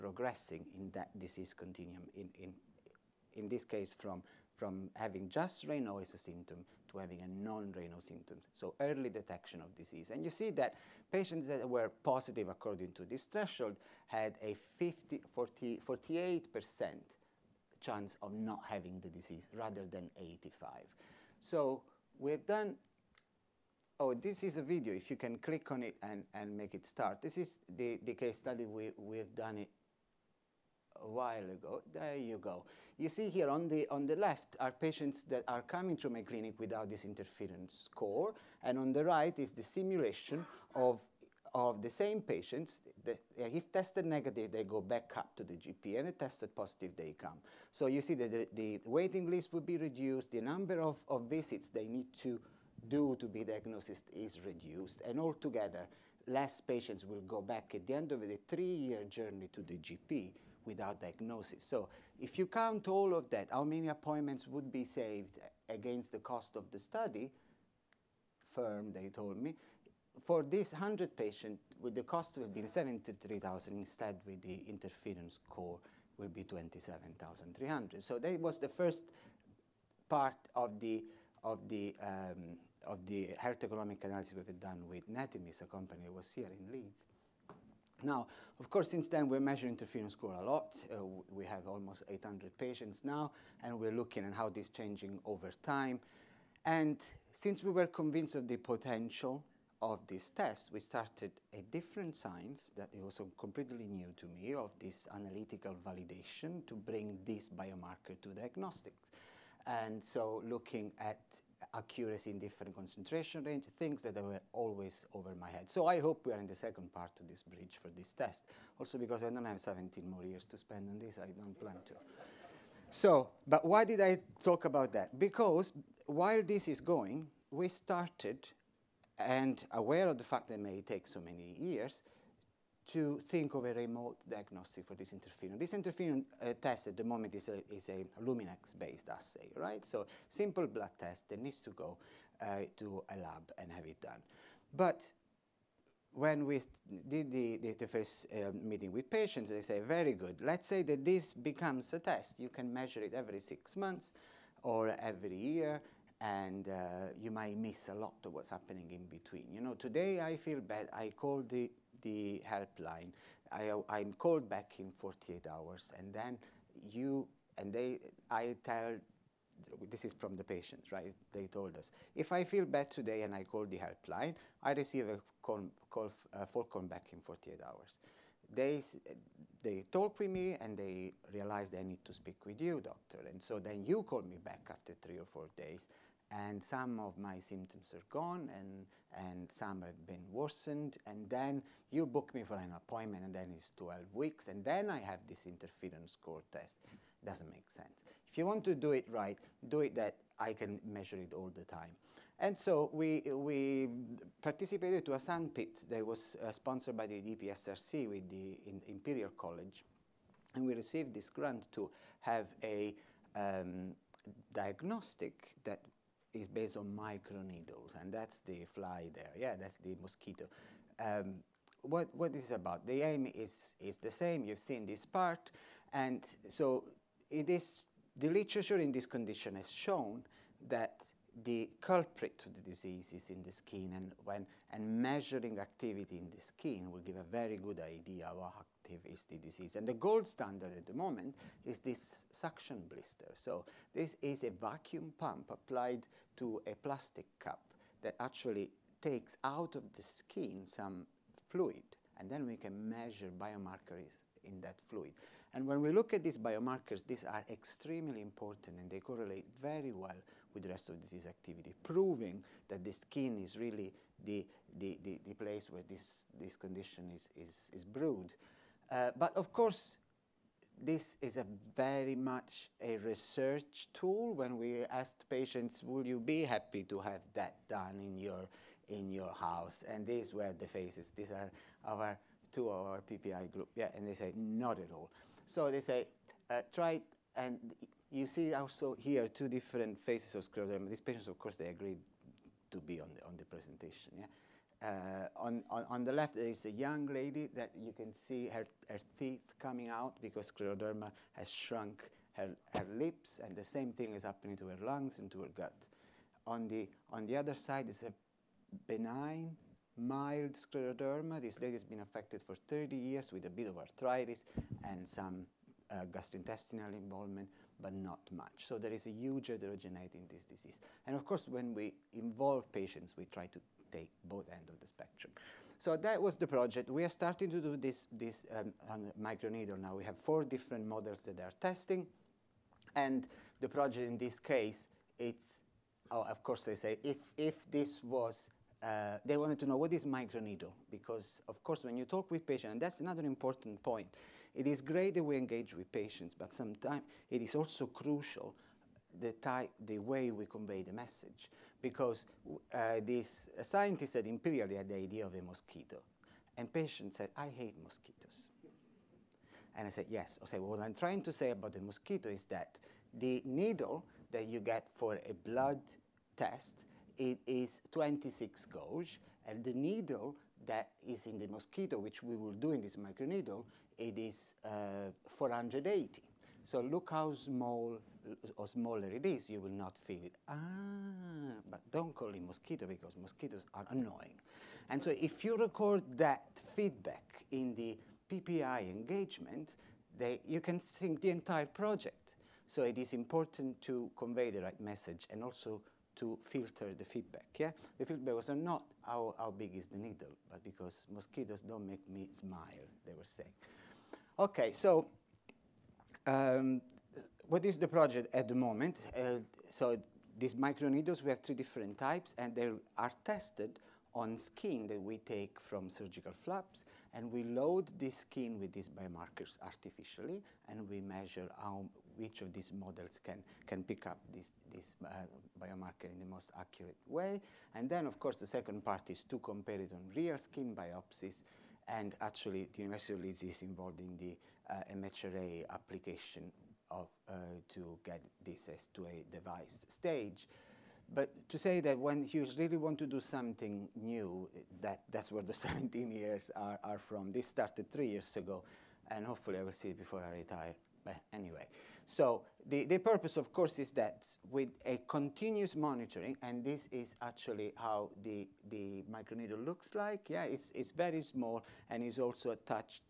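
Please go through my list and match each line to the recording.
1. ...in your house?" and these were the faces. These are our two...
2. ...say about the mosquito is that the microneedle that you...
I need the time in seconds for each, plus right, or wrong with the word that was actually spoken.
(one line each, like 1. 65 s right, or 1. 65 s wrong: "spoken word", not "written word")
1. 278 s right
2. 361 s wrong: "needle", not "microneedle".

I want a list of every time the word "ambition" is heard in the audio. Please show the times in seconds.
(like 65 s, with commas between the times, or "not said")
not said.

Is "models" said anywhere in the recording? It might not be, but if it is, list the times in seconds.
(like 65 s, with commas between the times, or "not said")
330 s, 422 s.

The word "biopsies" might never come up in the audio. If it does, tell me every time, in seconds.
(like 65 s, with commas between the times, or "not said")
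430 s.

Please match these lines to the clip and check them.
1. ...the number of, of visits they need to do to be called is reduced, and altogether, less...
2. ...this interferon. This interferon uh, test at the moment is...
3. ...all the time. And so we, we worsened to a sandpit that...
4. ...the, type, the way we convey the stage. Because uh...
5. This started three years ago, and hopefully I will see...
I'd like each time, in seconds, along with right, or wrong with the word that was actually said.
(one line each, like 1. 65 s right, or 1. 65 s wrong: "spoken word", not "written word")
1. 50 s wrong: "diagnosed", not "called"
2. 134 s right
3. 201 s wrong: "participated", not "worsened"
4. 349 s wrong: "message", not "stage"
5. 447 s right.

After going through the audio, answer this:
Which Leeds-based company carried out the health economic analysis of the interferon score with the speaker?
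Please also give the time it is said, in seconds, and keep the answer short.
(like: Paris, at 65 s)
Netimis, at 85 s.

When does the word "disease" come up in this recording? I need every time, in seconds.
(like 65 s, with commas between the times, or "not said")
1 s, 9 s, 19 s, 232 s, 239 s, 261 s, 320 s.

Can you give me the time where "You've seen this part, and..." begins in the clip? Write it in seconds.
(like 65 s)
224 s.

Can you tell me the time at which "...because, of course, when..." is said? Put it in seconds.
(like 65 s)
340 s.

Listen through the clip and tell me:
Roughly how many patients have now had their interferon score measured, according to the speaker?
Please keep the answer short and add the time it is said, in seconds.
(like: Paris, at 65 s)
almost 800, at 91 s.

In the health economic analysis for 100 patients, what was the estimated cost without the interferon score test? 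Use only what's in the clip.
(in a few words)
73,000.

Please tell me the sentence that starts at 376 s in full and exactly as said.
So look how small uh, or smaller it is, you will not feel it.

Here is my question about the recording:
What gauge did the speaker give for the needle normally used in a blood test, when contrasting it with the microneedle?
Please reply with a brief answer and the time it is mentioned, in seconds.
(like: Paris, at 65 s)
26, at 367 s.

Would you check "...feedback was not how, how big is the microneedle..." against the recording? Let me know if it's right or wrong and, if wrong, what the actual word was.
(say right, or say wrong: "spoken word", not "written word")
wrong: "needle", not "microneedle".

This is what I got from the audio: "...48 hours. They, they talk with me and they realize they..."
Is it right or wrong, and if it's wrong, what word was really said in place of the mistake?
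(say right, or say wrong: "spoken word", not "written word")
right.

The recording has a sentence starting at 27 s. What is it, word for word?
This is the, the case study we, we've done it a while ago.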